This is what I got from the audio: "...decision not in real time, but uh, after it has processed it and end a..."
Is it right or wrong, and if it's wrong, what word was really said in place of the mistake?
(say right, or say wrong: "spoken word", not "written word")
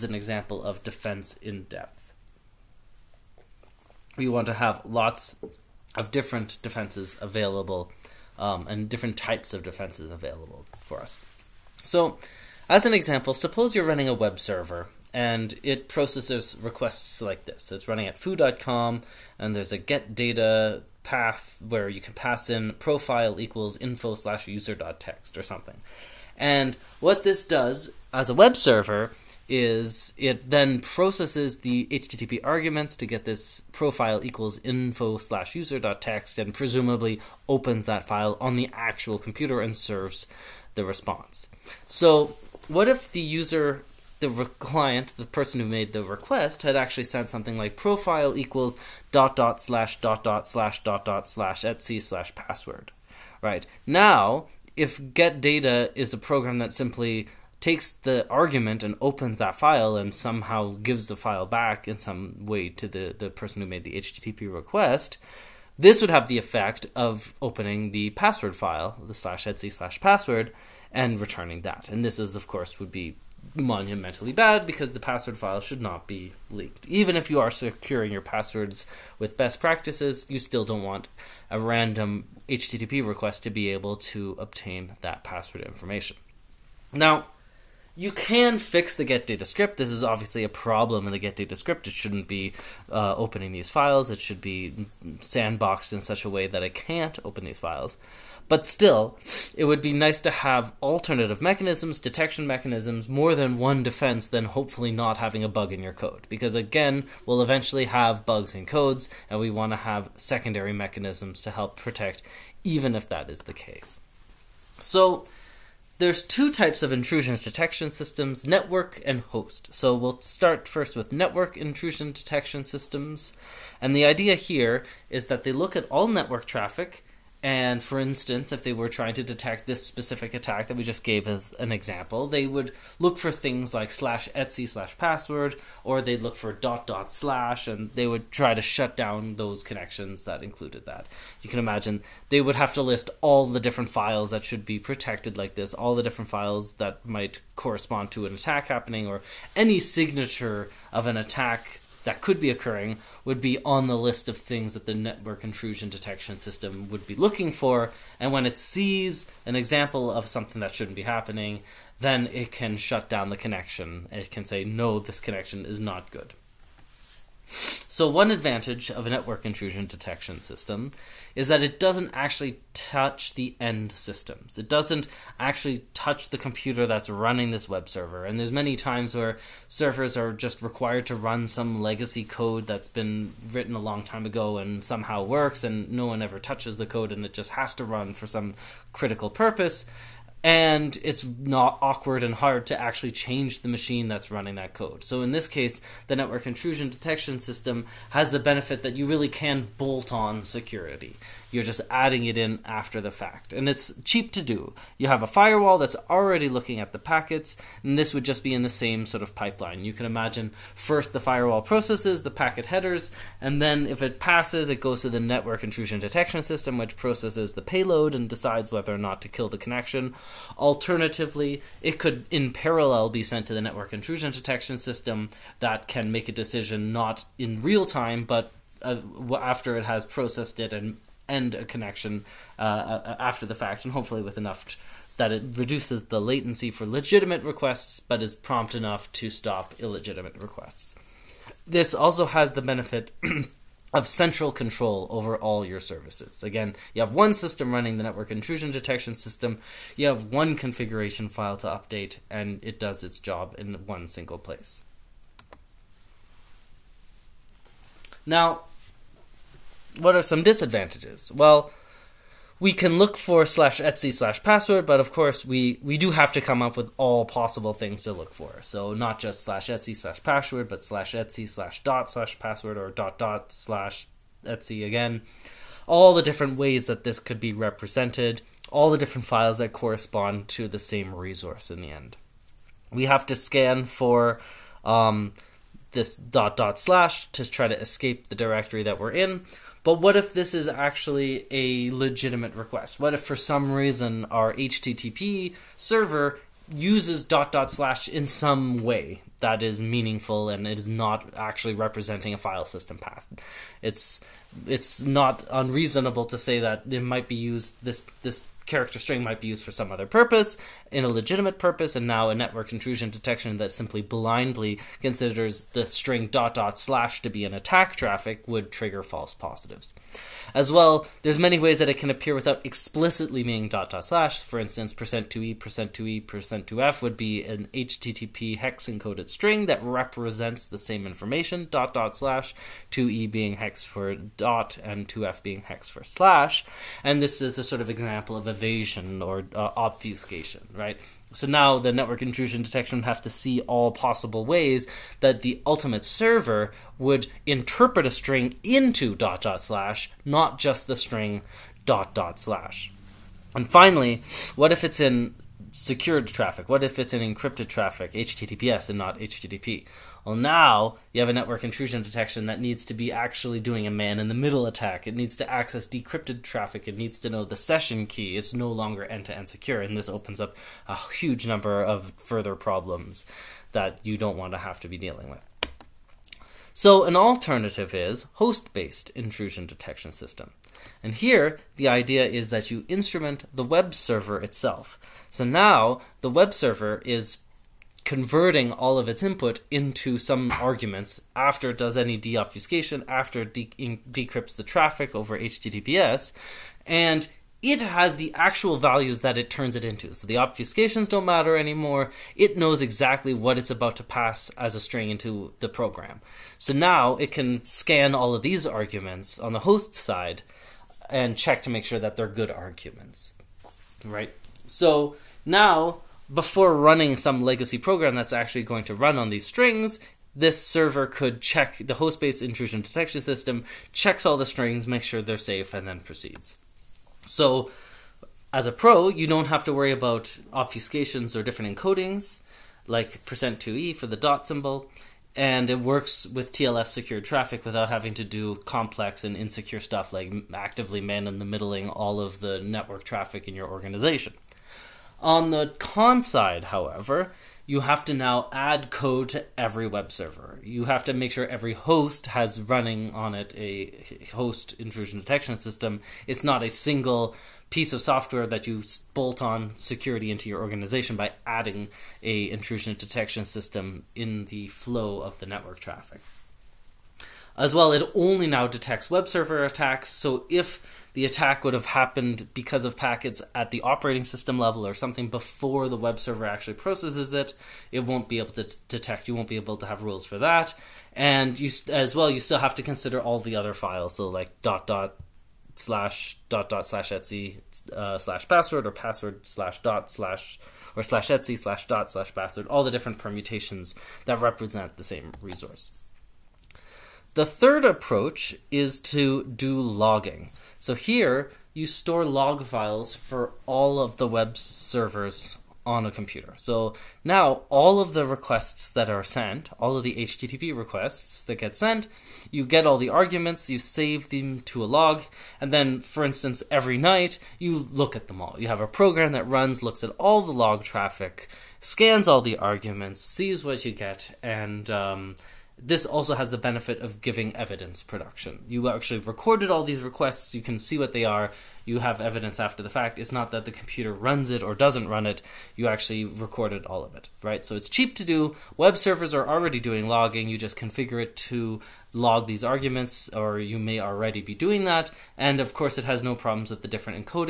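right.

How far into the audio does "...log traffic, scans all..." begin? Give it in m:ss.
8:40.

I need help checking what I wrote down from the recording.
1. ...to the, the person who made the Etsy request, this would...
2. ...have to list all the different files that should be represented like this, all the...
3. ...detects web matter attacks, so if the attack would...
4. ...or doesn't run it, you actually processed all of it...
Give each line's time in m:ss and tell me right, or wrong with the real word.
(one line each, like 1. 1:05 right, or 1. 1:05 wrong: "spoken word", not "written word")
1. 1:02 wrong: "HTTP", not "Etsy"
2. 2:22 wrong: "protected", not "represented"
3. 7:48 wrong: "server", not "matter"
4. 8:54 wrong: "recorded", not "processed".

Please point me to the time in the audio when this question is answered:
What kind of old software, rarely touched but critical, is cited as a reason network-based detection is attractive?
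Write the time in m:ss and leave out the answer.
3:01.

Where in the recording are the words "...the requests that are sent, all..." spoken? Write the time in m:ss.
8:28.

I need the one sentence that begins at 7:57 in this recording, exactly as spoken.
It won't be able to detect.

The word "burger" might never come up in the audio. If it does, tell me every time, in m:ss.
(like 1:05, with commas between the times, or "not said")
not said.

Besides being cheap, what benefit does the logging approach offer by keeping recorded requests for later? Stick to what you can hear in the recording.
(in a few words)
evidence production.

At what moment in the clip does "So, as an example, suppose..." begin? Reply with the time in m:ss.
0:11.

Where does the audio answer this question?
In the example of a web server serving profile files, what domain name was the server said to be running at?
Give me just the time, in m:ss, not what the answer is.
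0:18.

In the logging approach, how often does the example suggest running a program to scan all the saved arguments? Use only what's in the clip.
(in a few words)
every night.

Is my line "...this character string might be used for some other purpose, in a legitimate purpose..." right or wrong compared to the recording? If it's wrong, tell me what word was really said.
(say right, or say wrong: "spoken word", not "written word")
right.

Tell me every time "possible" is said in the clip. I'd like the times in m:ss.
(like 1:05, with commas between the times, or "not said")
4:27, 5:43.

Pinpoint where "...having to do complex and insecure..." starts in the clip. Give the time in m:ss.
7:17.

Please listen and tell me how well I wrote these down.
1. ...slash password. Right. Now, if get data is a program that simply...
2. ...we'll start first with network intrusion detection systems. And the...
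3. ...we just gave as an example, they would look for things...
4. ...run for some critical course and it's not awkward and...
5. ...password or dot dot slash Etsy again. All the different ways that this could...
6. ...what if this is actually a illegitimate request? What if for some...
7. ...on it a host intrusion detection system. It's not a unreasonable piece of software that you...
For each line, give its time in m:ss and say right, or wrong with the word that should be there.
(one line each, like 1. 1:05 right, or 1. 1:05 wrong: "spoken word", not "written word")
1. 0:51 right
2. 1:59 right
3. 2:10 right
4. 3:07 wrong: "purpose", not "course"
5. 4:32 right
6. 4:49 wrong: "legitimate", not "illegitimate"
7. 7:33 wrong: "single", not "unreasonable".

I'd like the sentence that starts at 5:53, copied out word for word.
And finally, what if it's in secured traffic?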